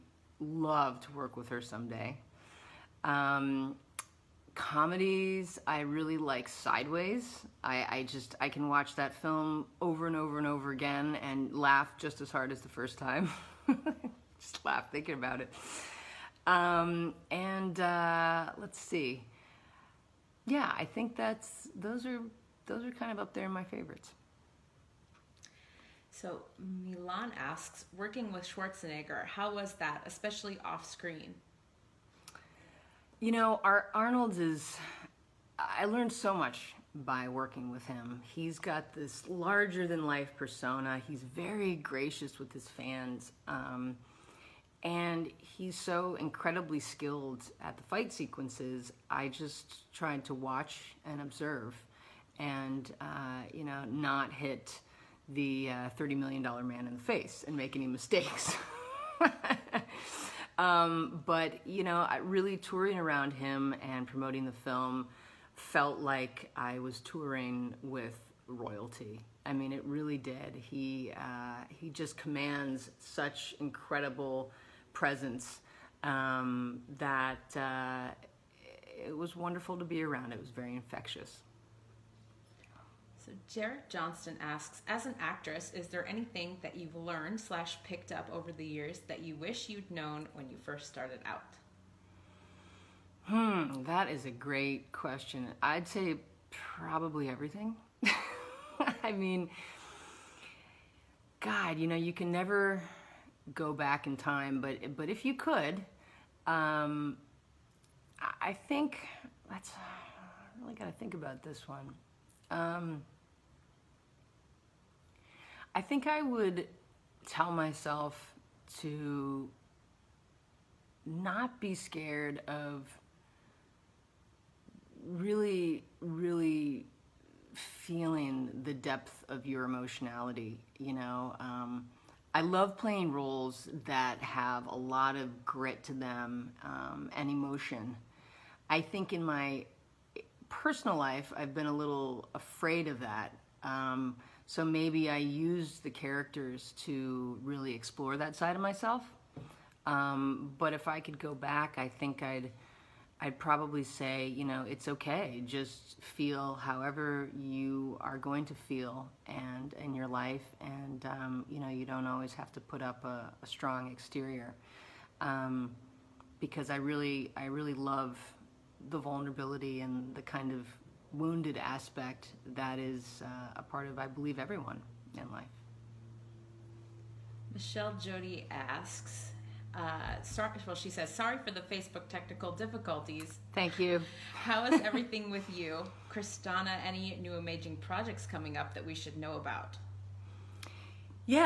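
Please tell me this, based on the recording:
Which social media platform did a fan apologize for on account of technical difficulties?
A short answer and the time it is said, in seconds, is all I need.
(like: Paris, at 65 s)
Facebook, at 181 s.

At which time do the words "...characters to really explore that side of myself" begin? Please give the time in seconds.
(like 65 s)
145 s.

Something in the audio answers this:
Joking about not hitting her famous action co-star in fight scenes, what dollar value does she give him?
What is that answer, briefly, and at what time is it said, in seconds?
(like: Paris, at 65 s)
$30 million, at 55 s.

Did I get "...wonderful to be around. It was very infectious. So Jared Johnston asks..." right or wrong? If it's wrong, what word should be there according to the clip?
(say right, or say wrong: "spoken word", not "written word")
right.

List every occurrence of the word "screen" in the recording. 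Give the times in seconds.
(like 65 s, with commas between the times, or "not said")
30 s.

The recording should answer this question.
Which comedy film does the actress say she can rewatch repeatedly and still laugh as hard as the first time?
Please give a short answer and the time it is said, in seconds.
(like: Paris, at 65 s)
Sideways, at 6 s.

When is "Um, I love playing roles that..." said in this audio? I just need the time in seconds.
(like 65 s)
131 s.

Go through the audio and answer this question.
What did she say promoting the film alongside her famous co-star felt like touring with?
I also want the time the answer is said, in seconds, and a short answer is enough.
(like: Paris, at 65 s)
Royalty, at 68 s.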